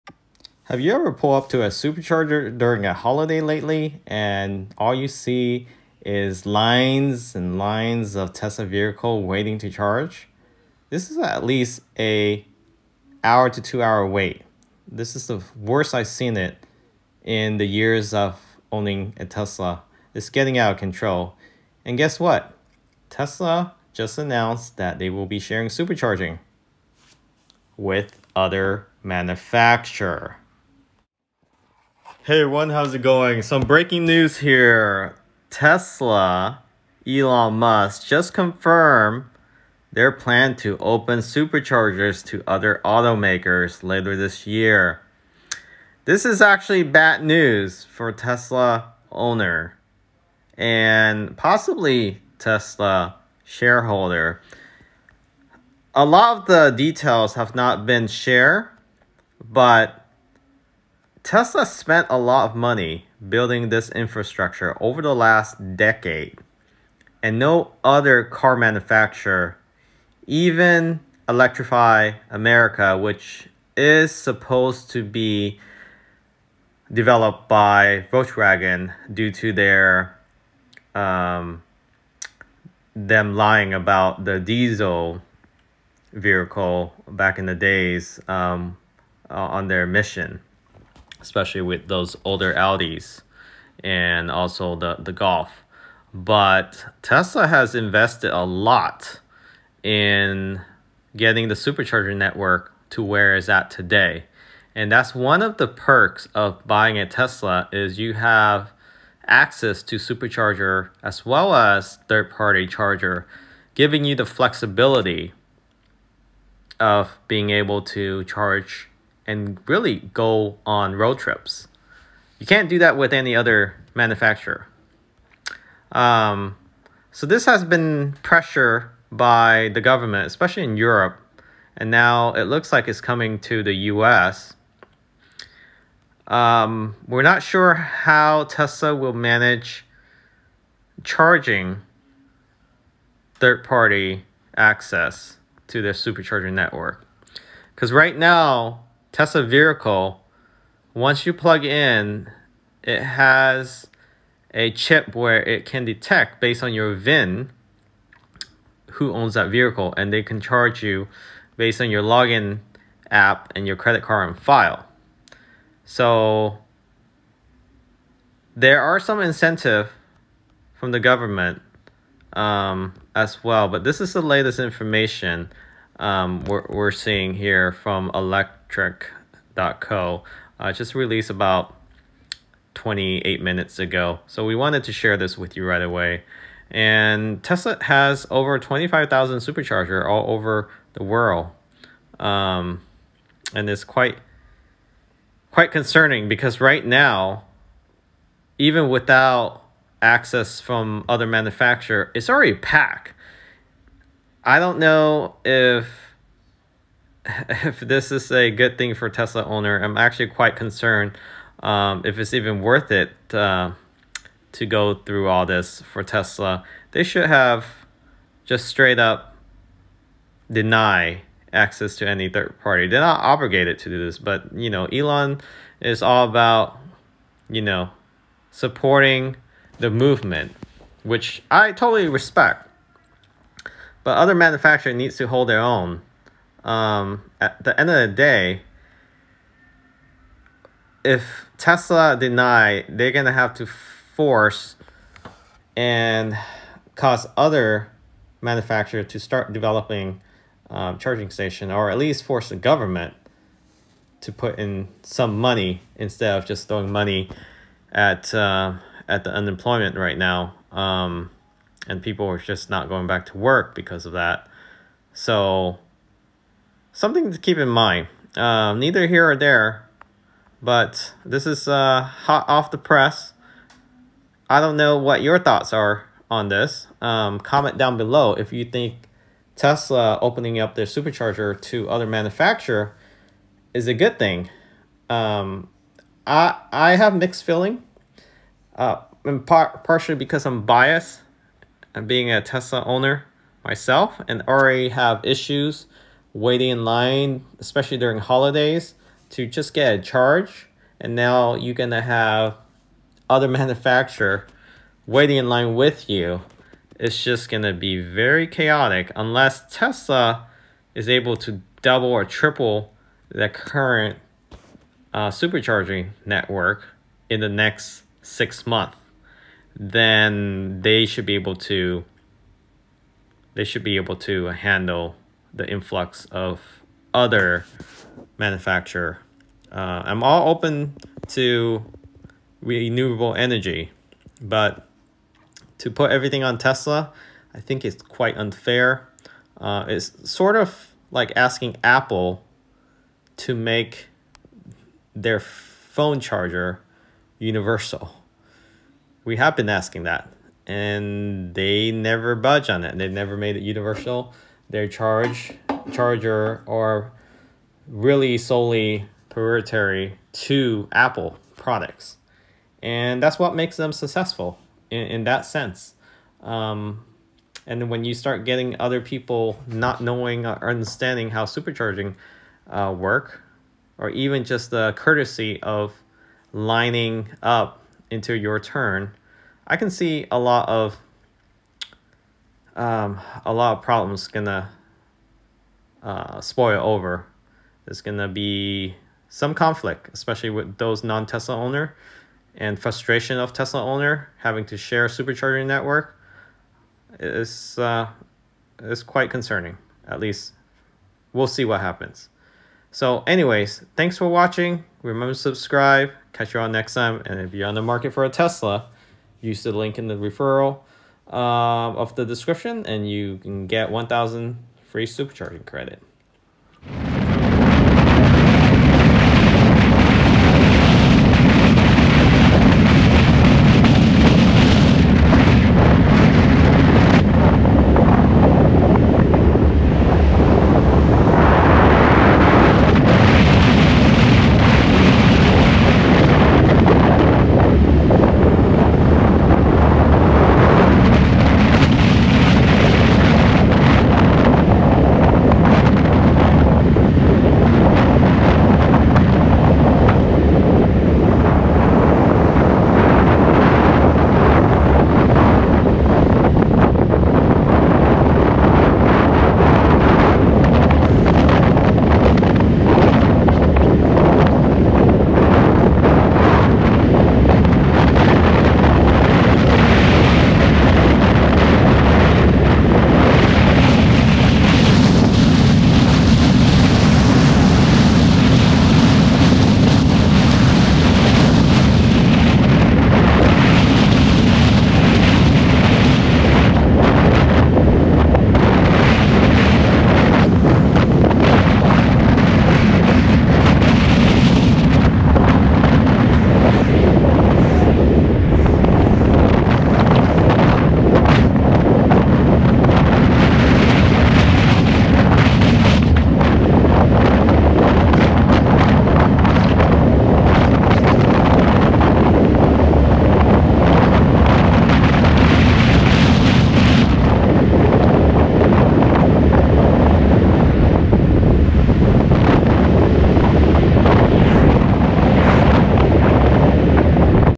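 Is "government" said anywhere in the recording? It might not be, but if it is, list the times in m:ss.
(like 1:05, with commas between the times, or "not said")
2:09, 2:50, 4:12.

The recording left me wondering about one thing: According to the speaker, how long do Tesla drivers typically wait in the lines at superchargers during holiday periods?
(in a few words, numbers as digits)
1 to 2 hours.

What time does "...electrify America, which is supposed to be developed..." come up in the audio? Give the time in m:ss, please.
1:11.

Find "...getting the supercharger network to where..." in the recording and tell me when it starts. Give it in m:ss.
1:41.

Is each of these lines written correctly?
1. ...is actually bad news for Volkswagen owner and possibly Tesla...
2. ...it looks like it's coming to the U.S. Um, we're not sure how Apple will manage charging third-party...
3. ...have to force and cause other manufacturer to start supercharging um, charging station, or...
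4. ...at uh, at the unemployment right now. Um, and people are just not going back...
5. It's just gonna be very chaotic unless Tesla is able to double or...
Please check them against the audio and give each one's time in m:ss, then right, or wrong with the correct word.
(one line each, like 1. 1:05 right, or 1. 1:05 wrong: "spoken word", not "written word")
1. 0:46 wrong: "Tesla", not "Volkswagen"
2. 2:12 wrong: "Tesla", not "Apple"
3. 4:03 wrong: "developing", not "supercharging"
4. 4:17 right
5. 5:06 right.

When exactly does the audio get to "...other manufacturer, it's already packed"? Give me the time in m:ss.
3:21.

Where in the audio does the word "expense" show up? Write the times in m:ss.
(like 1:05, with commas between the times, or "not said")
not said.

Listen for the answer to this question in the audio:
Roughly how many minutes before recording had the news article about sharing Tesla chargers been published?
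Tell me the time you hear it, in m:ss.
3:02.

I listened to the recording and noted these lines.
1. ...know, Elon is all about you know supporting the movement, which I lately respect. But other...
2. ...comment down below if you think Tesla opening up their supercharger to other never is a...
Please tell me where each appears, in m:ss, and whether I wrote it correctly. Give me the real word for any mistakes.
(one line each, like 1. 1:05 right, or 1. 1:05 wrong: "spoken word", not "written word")
1. 3:44 wrong: "totally", not "lately"
2. 4:37 wrong: "manufacturer", not "never".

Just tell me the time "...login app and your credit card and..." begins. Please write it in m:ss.
2:42.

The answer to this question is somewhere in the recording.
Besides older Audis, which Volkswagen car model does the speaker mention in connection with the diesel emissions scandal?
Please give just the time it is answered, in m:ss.
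1:35.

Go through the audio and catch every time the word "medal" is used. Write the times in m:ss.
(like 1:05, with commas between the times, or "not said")
not said.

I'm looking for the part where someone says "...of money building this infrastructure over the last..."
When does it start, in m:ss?
1:02.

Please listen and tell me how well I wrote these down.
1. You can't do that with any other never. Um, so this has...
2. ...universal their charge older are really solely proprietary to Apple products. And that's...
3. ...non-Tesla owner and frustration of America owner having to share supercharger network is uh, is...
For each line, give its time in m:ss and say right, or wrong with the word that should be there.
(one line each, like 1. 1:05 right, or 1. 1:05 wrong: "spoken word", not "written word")
1. 2:02 wrong: "manufacturer", not "never"
2. 5:53 wrong: "charger", not "older"
3. 6:31 wrong: "Tesla", not "America".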